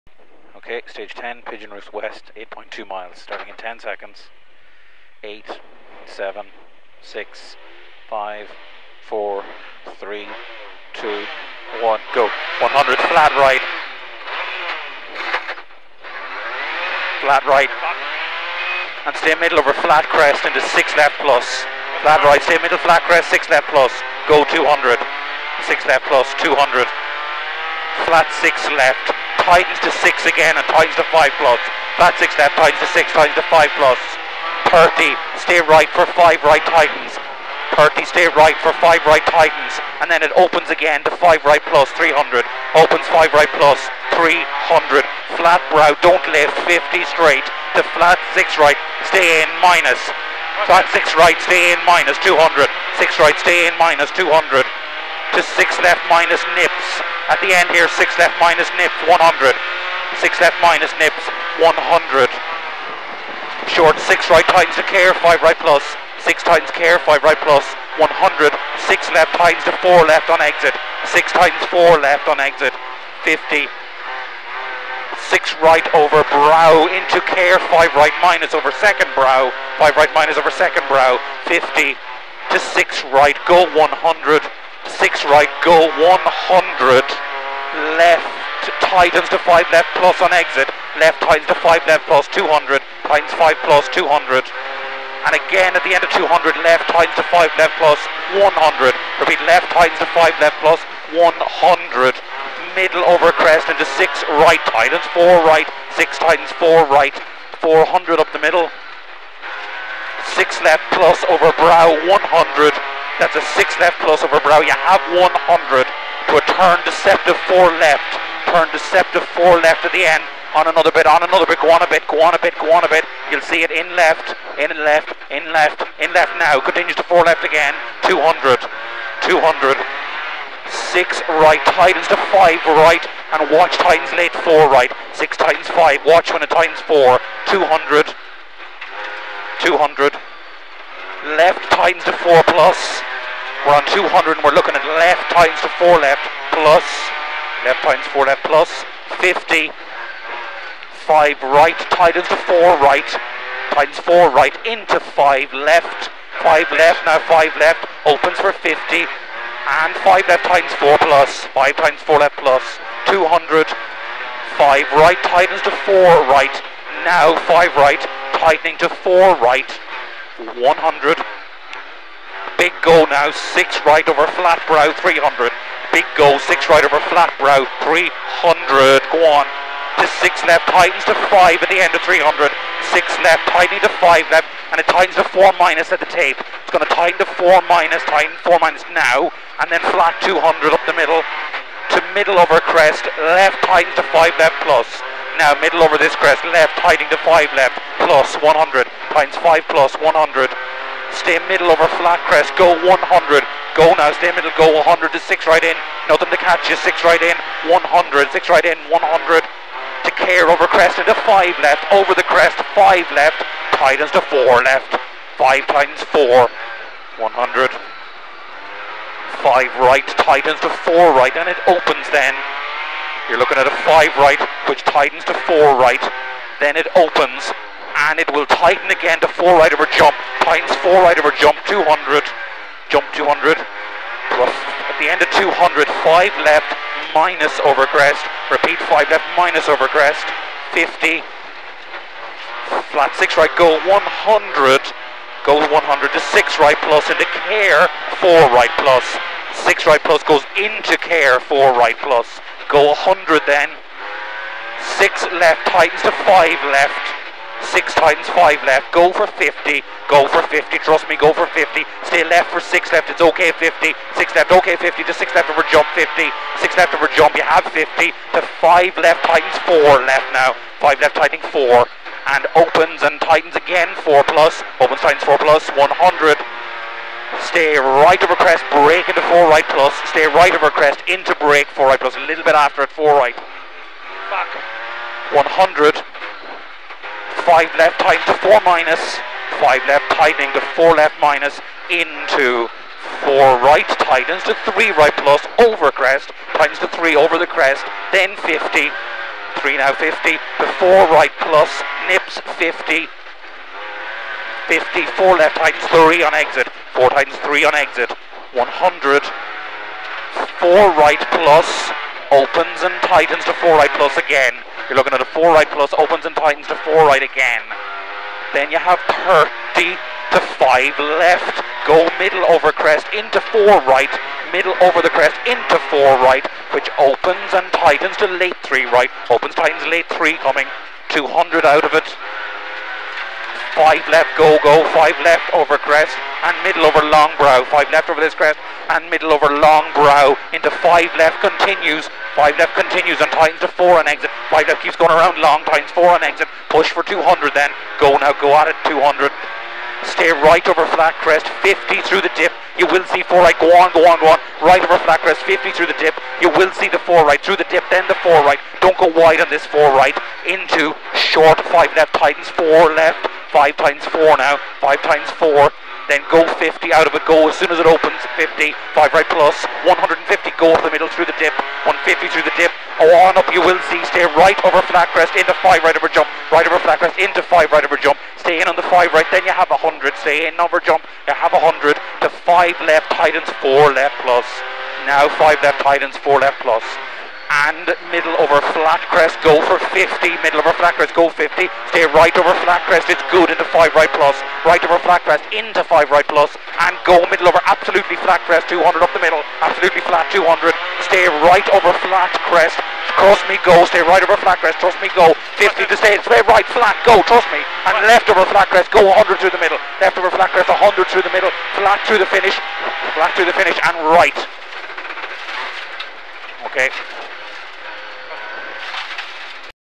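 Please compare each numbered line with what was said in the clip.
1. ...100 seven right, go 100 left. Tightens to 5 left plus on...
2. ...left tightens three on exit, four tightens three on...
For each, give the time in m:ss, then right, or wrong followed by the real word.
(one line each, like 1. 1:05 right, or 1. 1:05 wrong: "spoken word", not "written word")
1. 1:23 wrong: "six", not "seven"
2. 5:05 right.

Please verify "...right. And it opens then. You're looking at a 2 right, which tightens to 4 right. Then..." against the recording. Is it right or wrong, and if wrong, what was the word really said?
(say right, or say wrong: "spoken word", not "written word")
wrong: "5", not "2".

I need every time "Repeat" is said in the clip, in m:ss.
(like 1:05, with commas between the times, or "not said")
1:39, 3:58.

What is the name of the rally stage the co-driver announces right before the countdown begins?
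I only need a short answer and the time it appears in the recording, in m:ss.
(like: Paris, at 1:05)
Pigeon Roost West, at 0:01.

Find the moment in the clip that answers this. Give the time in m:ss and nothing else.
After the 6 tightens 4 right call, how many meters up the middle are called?
1:47.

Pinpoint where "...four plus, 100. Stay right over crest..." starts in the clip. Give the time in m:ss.
4:35.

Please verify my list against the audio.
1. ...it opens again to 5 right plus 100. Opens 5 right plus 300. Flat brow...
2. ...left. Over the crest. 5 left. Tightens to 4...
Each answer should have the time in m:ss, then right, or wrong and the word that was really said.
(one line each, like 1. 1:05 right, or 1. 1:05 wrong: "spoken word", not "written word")
1. 0:40 wrong: "300", not "100"
2. 3:31 right.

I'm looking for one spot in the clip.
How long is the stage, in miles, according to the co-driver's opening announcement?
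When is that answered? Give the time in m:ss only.
0:02.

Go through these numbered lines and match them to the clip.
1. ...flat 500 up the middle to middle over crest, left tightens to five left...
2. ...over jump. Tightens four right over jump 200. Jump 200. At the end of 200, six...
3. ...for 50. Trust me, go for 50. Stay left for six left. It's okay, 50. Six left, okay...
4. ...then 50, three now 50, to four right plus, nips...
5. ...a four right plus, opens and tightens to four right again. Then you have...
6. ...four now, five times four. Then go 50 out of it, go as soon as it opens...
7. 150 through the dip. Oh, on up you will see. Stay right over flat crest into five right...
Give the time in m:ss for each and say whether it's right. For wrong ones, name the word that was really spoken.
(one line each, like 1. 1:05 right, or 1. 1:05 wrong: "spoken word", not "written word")
1. 3:09 wrong: "200", not "500"
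2. 3:49 wrong: "five", not "six"
3. 4:20 right
4. 4:58 right
5. 5:15 right
6. 6:04 right
7. 6:11 right.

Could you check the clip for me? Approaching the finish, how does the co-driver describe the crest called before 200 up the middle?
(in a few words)
absolutely flat crest.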